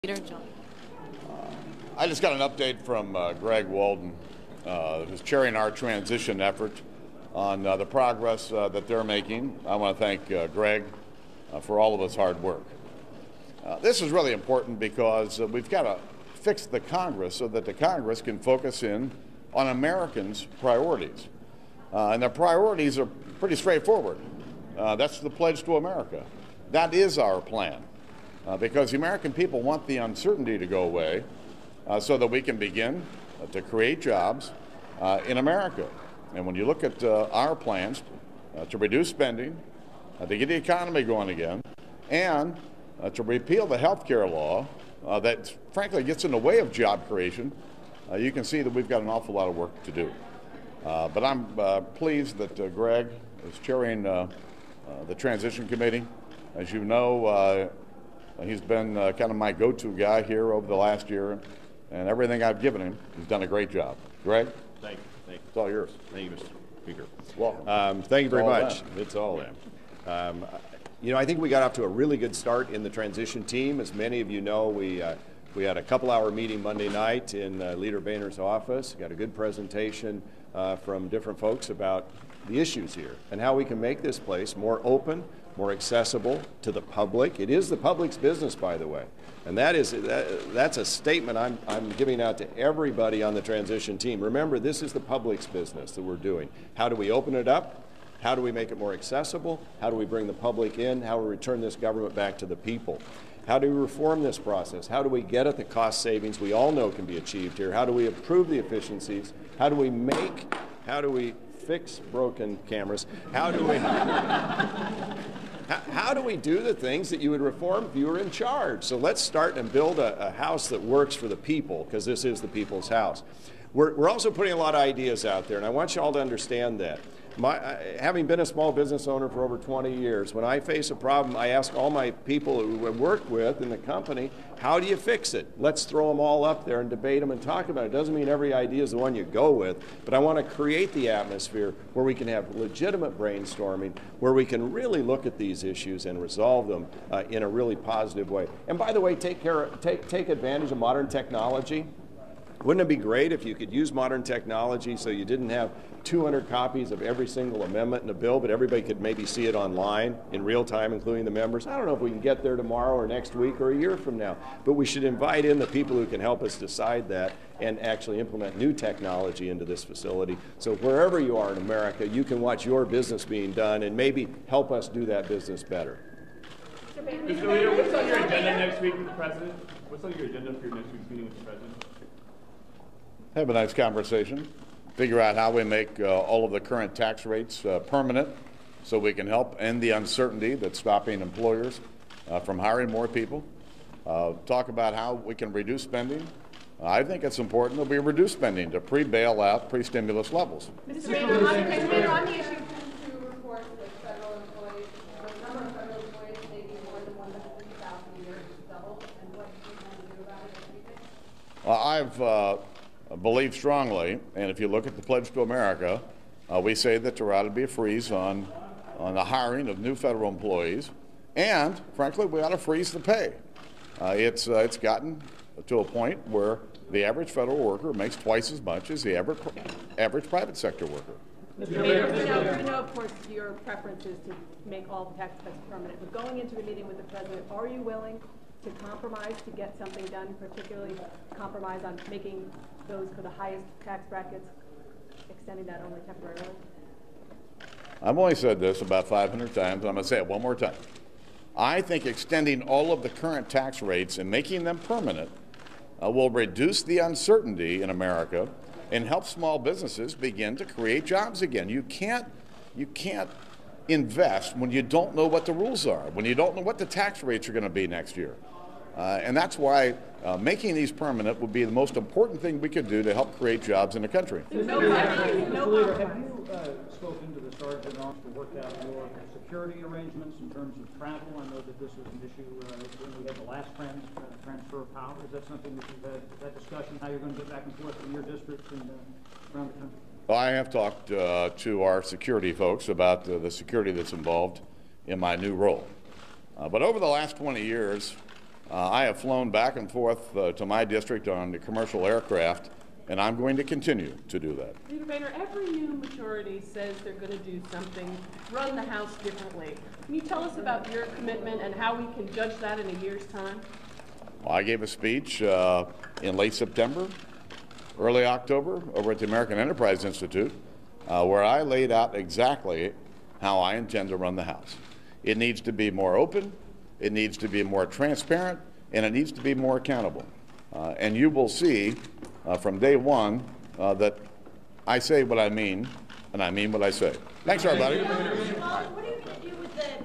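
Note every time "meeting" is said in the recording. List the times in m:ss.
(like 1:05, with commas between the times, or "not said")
1:16, 3:01, 3:56.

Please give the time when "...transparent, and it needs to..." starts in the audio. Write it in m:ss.
5:27.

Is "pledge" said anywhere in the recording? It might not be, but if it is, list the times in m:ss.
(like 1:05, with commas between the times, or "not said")
0:25, 3:35.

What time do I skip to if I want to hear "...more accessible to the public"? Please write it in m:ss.
1:25.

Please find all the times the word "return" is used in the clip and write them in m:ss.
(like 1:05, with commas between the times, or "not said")
1:41.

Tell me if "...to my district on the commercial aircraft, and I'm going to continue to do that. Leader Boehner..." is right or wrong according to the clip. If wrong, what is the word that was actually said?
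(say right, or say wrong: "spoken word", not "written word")
right.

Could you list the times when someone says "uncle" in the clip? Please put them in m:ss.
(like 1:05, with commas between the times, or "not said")
not said.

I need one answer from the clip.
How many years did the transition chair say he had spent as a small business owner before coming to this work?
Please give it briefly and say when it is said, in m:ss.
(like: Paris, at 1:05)
over 20 years, at 2:09.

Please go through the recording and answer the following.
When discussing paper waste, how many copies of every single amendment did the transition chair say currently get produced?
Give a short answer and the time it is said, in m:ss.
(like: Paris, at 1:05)
200, at 2:36.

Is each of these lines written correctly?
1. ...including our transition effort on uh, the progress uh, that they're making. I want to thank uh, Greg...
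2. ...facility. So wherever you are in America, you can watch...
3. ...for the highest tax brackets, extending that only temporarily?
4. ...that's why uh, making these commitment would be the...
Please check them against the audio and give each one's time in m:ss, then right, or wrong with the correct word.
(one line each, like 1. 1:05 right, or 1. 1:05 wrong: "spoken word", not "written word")
1. 0:05 wrong: "chairing", not "including"
2. 2:49 right
3. 4:03 right
4. 4:29 wrong: "permanent", not "commitment".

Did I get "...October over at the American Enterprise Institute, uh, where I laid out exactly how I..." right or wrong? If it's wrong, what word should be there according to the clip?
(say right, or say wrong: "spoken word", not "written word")
right.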